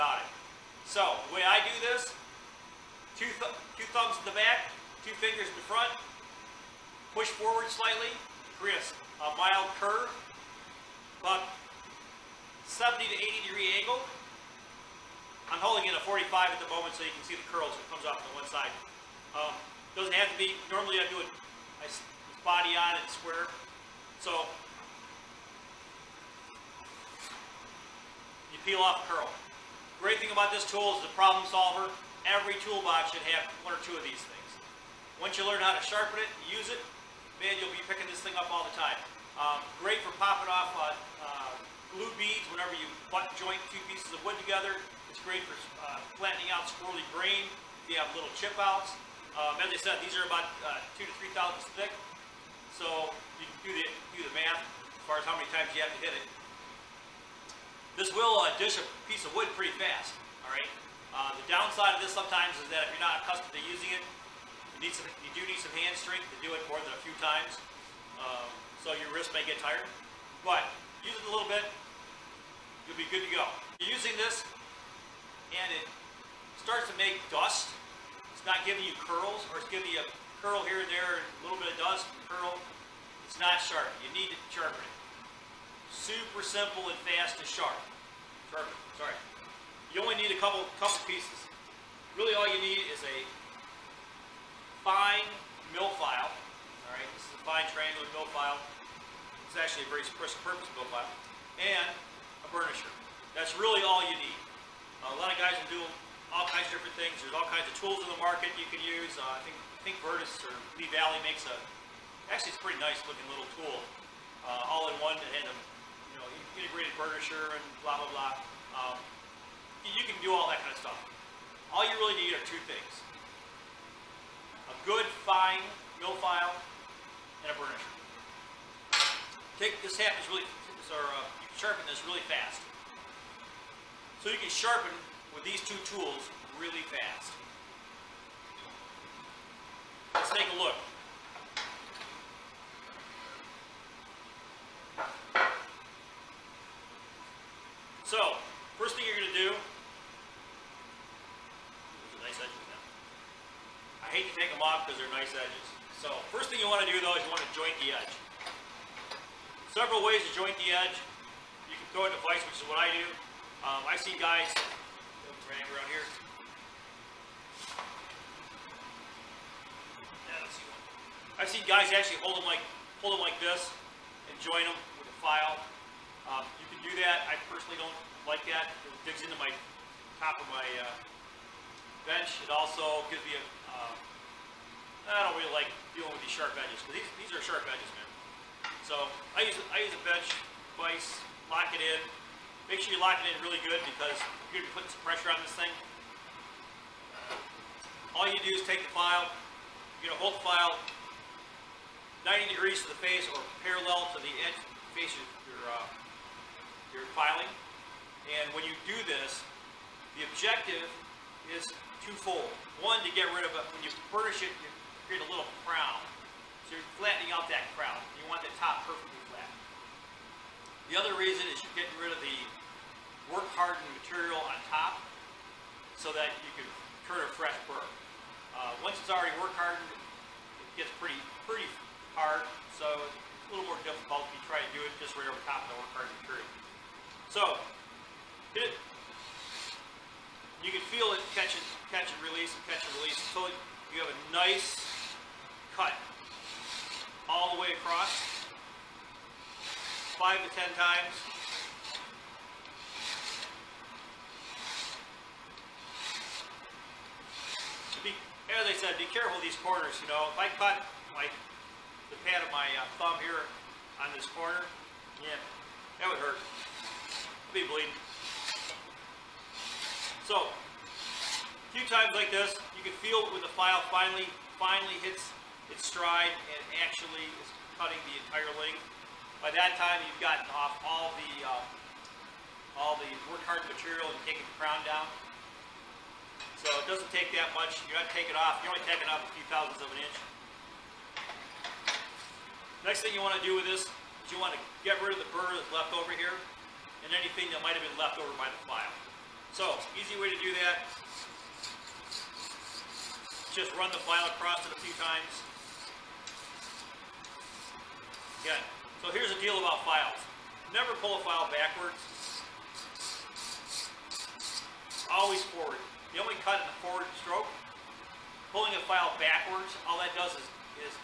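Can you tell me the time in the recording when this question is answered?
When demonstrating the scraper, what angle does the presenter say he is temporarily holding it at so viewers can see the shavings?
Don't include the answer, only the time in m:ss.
0:16.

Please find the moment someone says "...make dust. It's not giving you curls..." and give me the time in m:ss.
1:16.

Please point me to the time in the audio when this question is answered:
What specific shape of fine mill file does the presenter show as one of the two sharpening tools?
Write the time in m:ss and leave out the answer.
1:37.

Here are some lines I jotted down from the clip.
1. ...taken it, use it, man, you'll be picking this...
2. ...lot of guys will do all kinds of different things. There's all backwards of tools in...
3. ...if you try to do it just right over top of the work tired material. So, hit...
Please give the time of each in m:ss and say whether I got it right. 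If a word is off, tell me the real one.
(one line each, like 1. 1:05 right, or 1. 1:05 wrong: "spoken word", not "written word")
1. 0:35 wrong: "sharpen", not "taken"
2. 1:45 wrong: "kinds", not "backwards"
3. 3:54 wrong: "hardened", not "tired".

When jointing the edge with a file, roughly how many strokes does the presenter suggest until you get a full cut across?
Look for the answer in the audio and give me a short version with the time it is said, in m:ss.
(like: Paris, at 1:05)
5 to 10, at 4:10.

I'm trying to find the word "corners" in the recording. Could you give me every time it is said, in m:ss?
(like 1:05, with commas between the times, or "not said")
4:19, 4:24.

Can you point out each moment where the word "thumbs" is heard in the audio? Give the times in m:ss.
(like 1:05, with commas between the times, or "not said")
0:03, 4:23.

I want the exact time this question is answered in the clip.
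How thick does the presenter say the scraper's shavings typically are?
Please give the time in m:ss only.
0:51.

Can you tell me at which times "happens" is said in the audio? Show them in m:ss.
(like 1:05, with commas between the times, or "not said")
2:09.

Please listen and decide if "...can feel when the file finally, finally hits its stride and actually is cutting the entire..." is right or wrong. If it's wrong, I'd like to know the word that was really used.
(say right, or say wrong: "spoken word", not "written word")
right.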